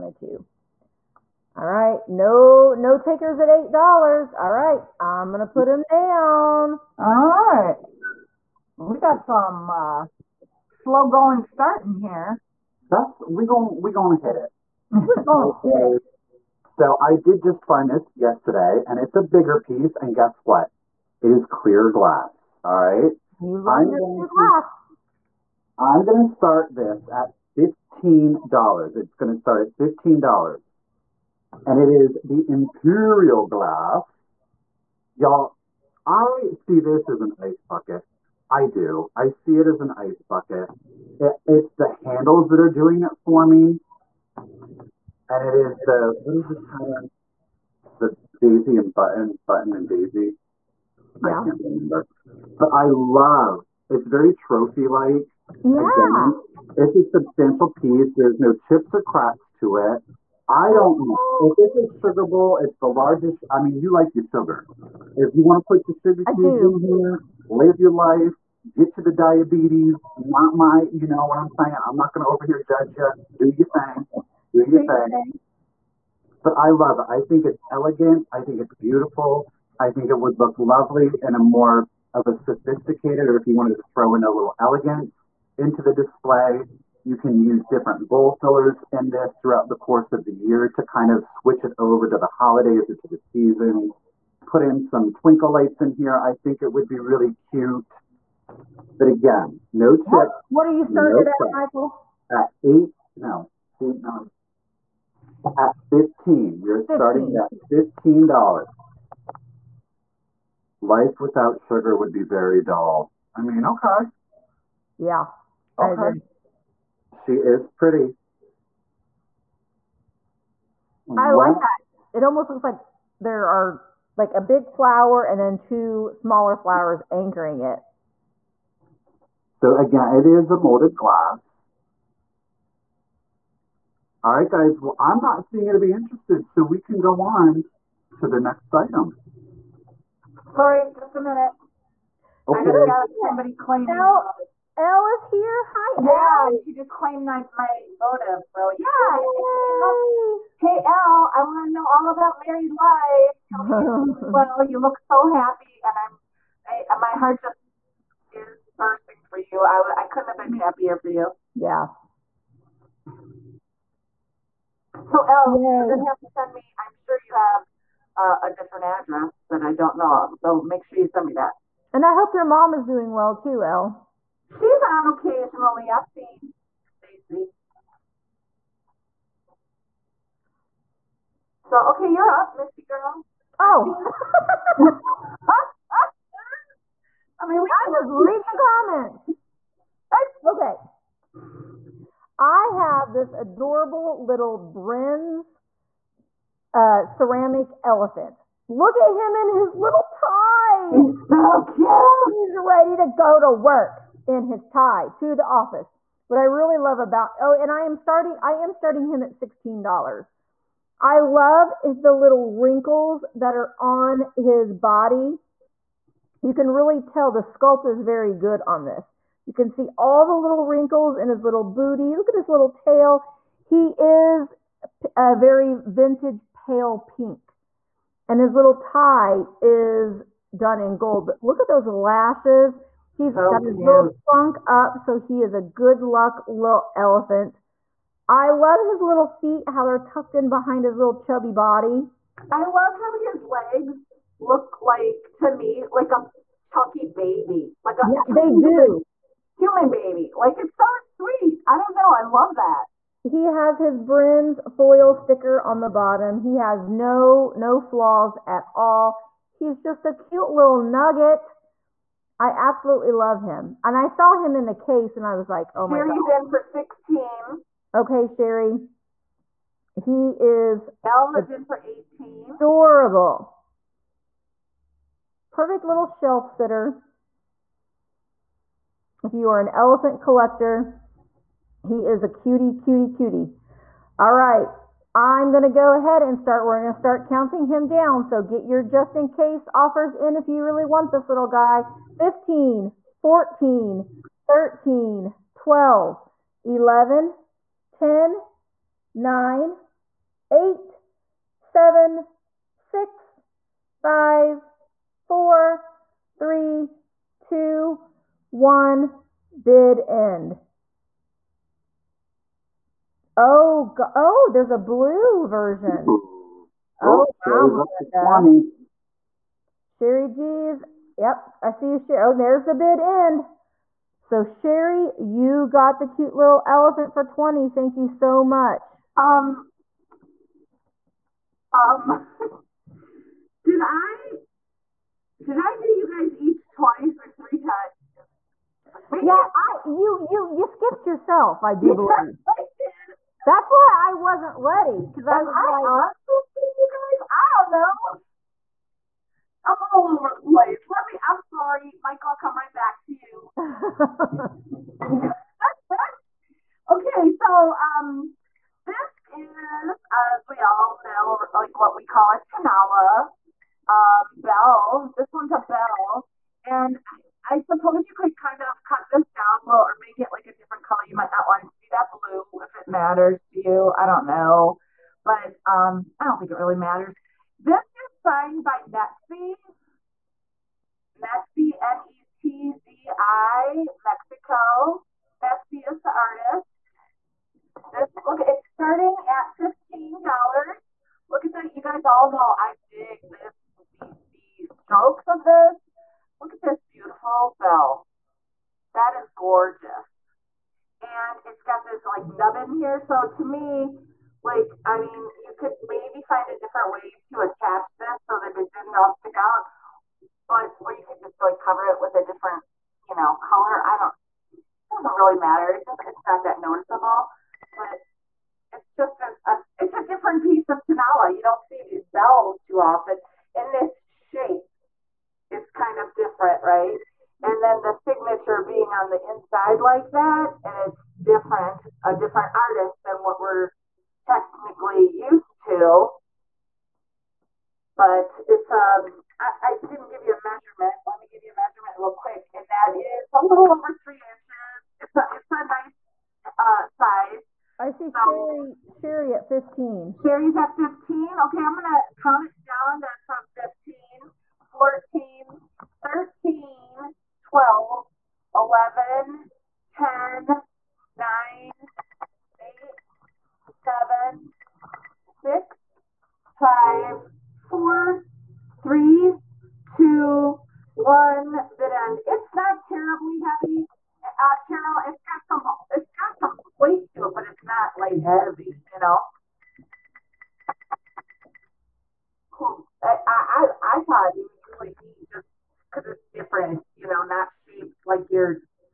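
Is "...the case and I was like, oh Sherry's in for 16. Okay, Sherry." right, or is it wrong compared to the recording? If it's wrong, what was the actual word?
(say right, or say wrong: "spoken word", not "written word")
right.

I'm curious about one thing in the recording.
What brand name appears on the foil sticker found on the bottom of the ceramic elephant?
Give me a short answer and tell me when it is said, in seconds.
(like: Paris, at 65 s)
Brinns, at 253 s.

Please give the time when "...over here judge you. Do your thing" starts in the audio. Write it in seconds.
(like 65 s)
72 s.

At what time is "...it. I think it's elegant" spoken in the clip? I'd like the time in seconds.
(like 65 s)
76 s.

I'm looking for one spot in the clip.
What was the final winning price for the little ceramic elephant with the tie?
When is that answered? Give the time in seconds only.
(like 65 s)
327 s.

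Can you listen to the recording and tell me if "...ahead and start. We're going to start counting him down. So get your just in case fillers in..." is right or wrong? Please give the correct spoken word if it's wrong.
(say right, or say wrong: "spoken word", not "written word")
wrong: "offers", not "fillers".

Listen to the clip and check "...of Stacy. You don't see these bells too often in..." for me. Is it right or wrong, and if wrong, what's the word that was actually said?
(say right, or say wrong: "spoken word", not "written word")
wrong: "Tonala", not "Stacy".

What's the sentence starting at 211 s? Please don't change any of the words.
I love the little wrinkles that are on his body.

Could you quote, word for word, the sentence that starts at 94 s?
Put in some twinkle lights in here.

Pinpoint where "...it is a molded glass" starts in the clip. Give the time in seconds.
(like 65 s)
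130 s.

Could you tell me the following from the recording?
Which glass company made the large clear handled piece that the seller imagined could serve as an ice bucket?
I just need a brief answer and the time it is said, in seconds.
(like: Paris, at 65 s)
Imperial Glass, at 32 s.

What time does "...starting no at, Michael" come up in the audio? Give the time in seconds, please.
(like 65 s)
100 s.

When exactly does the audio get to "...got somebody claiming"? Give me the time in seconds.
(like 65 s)
142 s.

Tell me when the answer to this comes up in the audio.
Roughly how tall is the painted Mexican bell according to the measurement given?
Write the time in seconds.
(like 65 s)
443 s.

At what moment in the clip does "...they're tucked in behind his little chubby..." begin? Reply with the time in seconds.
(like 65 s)
239 s.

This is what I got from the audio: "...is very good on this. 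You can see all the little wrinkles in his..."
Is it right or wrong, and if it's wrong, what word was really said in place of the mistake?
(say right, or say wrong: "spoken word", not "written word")
right.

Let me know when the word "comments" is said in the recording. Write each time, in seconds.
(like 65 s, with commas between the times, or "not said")
188 s.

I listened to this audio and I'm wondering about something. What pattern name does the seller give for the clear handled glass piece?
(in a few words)
Daisy and Button.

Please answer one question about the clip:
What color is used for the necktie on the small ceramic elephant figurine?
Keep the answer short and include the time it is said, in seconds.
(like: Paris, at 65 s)
Gold, at 230 s.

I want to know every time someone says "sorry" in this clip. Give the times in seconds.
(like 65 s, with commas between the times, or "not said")
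140 s, 351 s.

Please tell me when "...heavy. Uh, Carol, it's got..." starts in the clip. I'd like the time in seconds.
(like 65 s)
473 s.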